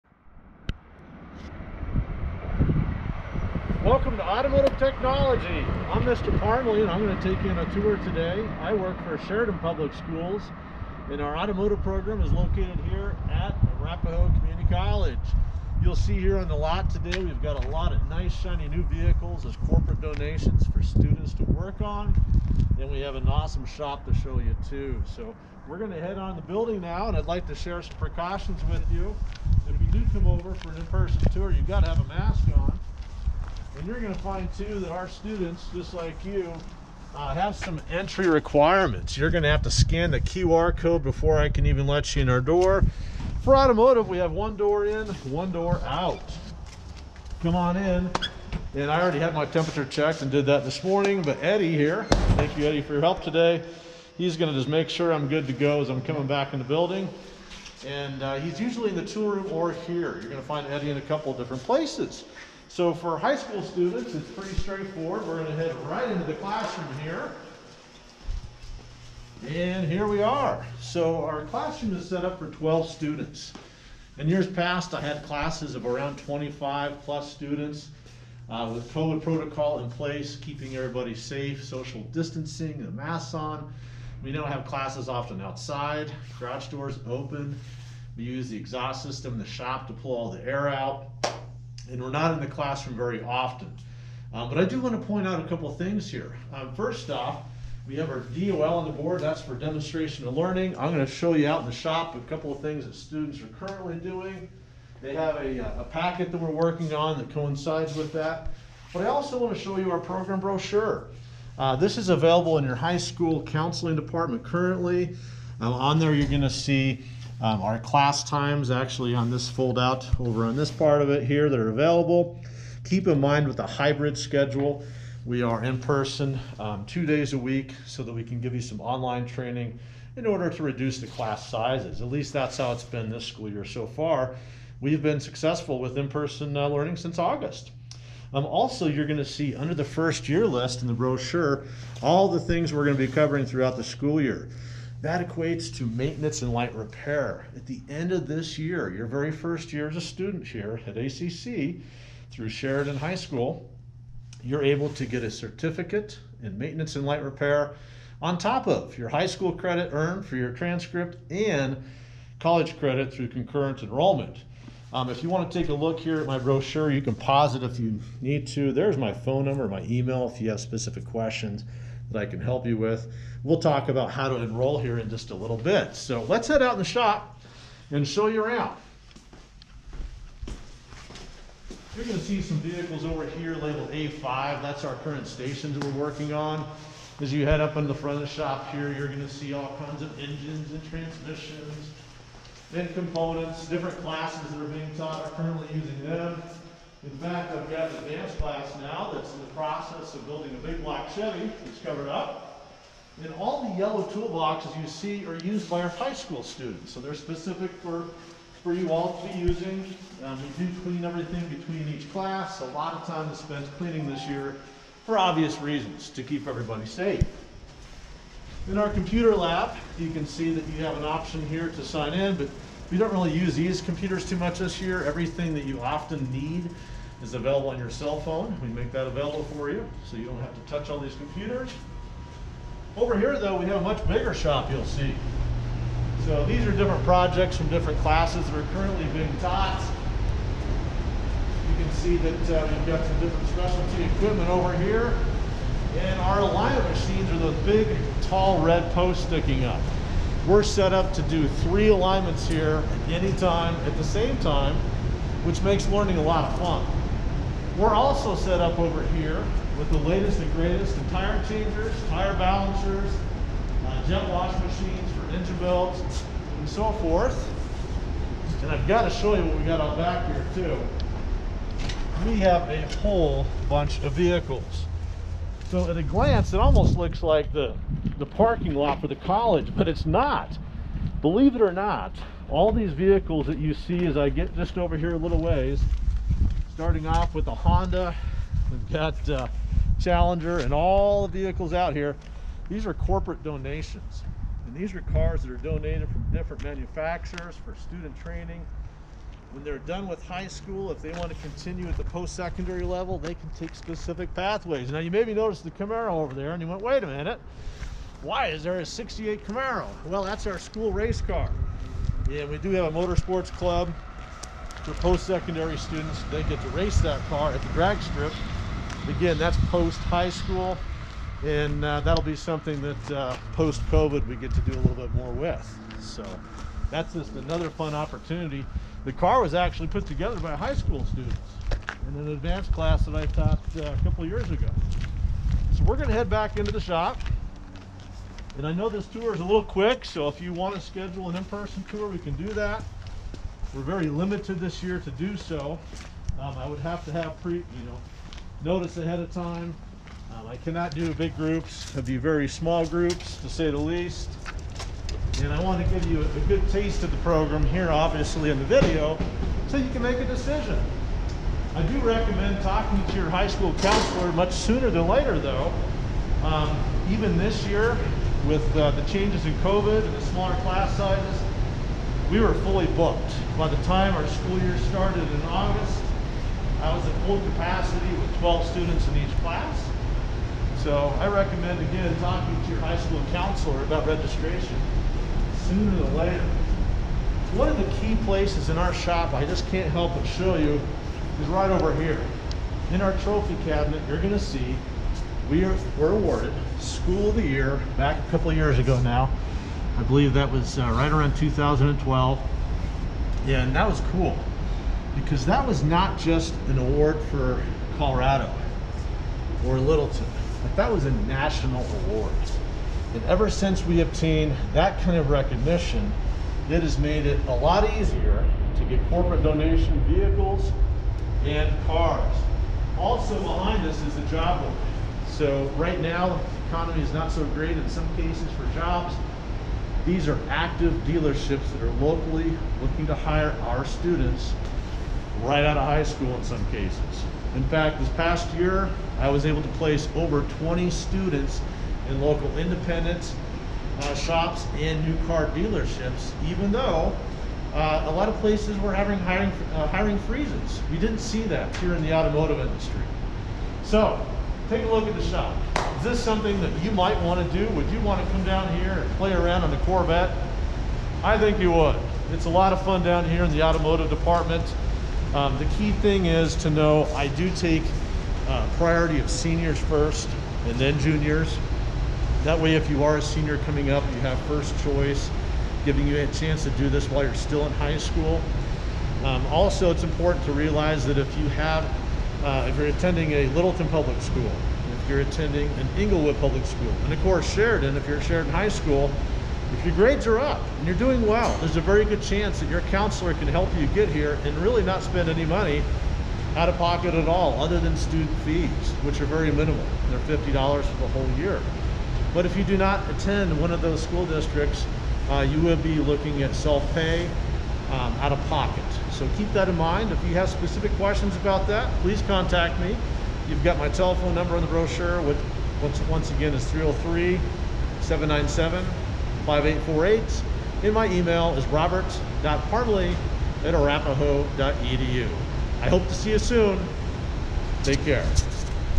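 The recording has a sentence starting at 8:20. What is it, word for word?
They're $50 for the whole year.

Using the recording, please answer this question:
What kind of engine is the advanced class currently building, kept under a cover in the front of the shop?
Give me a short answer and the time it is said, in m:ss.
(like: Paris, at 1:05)
big block Chevy, at 3:20.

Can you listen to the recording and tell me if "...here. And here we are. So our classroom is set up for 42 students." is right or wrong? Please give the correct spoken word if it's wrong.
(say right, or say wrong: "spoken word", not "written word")
wrong: "12", not "42".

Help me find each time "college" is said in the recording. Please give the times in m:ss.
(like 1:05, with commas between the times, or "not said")
0:14, 2:42, 4:39.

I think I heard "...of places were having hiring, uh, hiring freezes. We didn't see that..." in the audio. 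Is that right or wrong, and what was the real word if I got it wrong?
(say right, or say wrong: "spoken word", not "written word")
right.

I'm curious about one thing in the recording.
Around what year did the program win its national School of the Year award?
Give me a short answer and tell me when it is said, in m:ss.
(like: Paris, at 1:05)
2012, at 6:41.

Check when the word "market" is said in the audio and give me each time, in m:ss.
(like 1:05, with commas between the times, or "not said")
7:04.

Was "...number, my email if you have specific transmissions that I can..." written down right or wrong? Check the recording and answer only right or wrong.
wrong.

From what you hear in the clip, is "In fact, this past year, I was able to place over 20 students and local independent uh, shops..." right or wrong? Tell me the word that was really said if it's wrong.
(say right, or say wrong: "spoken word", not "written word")
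right.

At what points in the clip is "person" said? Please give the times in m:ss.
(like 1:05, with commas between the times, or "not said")
0:30, 2:05, 2:15, 5:41.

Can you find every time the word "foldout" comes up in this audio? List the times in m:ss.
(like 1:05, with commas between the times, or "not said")
1:59.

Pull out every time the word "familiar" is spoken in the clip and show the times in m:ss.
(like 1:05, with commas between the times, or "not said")
not said.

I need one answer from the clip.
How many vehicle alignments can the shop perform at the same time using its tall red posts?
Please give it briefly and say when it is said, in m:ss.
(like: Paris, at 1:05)
3, at 4:11.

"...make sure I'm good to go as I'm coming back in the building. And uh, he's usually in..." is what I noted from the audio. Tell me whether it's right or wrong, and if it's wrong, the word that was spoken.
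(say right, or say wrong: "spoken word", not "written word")
right.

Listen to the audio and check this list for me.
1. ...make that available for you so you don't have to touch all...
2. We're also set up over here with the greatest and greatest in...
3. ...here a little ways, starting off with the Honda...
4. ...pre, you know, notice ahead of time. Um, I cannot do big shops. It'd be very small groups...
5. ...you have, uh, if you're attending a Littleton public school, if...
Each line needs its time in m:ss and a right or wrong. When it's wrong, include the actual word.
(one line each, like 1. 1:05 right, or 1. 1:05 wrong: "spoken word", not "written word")
1. 3:48 right
2. 4:17 wrong: "latest", not "greatest"
3. 4:44 right
4. 5:47 wrong: "groups", not "shops"
5. 8:01 right.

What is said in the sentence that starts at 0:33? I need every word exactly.
And you're going to find too that our students, just like you, uh, have some entry requirements.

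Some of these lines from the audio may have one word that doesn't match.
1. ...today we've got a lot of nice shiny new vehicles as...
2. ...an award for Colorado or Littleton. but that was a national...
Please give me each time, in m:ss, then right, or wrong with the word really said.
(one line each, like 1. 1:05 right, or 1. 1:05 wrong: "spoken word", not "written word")
1. 0:16 right
2. 6:46 right.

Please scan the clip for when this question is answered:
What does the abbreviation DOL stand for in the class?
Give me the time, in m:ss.
1:39.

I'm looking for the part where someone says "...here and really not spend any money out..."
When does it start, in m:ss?
8:14.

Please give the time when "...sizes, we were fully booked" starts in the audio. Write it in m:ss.
6:10.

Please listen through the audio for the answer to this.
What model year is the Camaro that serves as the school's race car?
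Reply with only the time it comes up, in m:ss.
5:08.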